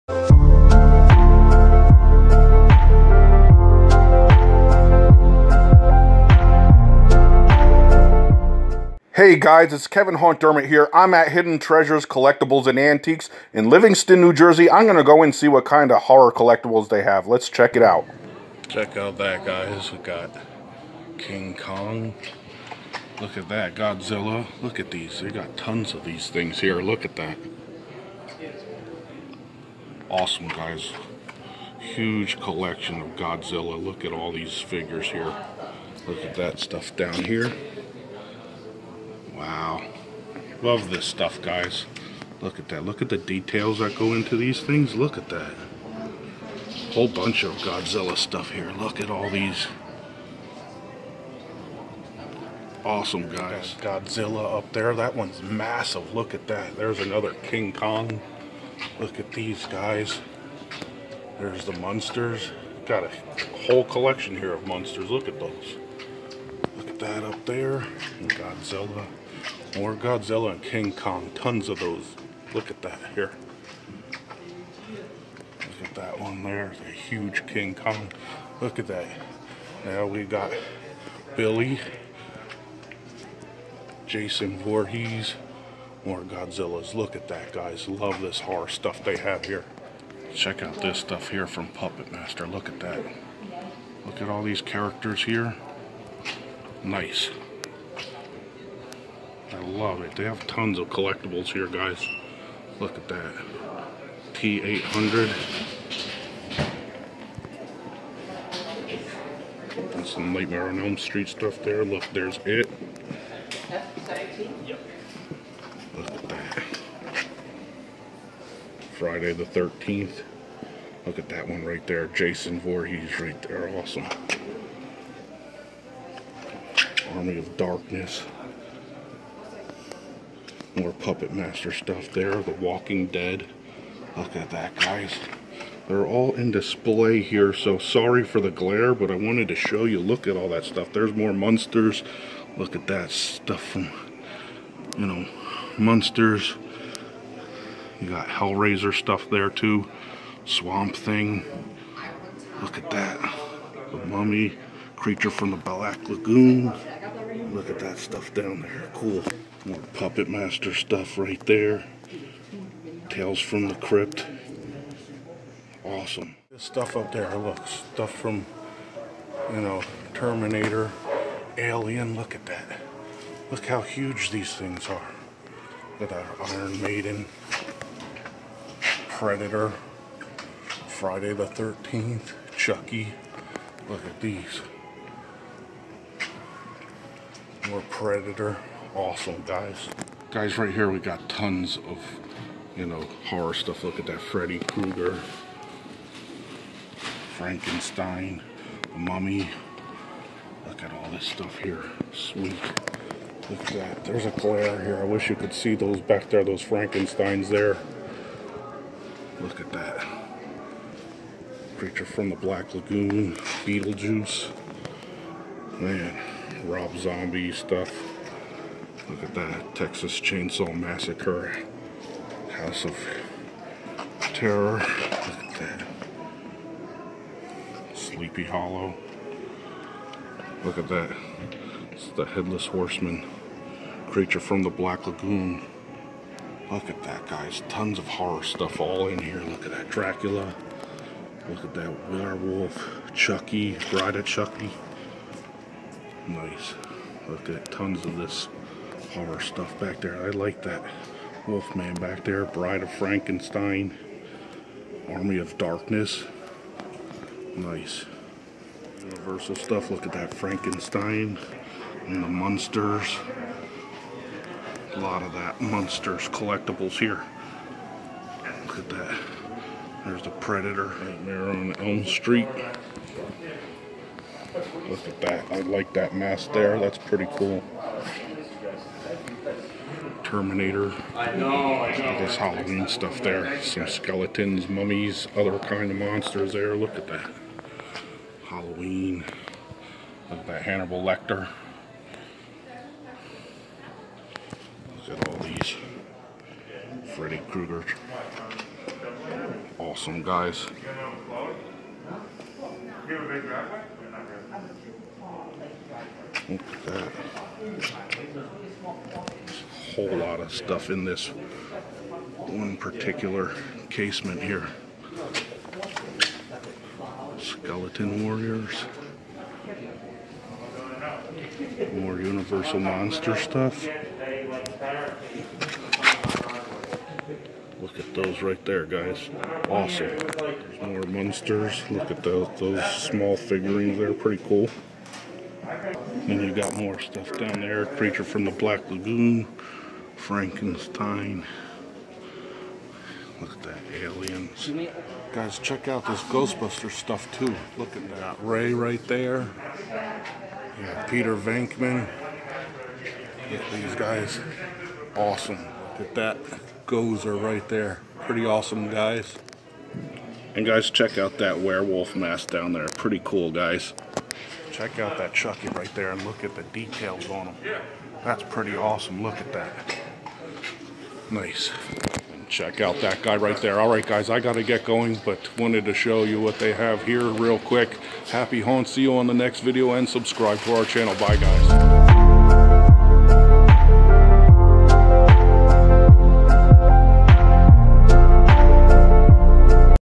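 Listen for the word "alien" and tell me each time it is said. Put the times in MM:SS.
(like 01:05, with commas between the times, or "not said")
02:51, 05:44.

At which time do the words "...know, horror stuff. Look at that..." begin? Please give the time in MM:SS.
03:12.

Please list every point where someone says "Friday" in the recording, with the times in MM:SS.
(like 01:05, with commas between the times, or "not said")
01:58, 03:00.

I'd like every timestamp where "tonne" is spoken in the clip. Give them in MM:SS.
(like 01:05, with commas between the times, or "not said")
not said.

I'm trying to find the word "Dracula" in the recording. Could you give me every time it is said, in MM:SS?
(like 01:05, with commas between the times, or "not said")
03:59.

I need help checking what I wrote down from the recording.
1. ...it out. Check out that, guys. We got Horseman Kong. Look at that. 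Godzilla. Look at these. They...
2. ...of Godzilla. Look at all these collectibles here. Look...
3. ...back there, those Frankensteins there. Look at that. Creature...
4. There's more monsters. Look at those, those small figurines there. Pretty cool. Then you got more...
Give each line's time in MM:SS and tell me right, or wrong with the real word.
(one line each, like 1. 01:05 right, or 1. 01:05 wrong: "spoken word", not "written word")
1. 00:17 wrong: "King", not "Horseman"
2. 00:33 wrong: "figures", not "collectibles"
3. 03:26 right
4. 05:30 right.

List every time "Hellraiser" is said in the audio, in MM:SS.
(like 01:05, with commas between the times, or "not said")
02:28.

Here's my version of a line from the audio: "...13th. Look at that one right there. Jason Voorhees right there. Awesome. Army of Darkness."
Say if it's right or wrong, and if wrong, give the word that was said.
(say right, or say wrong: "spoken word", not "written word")
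right.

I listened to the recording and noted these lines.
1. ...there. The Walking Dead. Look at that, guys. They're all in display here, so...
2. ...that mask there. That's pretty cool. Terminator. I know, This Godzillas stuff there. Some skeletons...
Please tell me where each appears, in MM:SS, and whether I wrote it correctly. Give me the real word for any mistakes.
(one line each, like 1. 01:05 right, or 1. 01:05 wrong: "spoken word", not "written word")
1. 02:12 right
2. 04:35 wrong: "Halloween", not "Godzillas".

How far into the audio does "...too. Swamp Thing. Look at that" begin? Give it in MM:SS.
02:29.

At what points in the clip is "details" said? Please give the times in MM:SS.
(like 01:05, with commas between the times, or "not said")
00:43, 06:06.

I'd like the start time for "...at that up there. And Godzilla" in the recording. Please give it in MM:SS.
01:06.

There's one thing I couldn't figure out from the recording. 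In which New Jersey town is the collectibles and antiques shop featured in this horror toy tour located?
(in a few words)
Livingston.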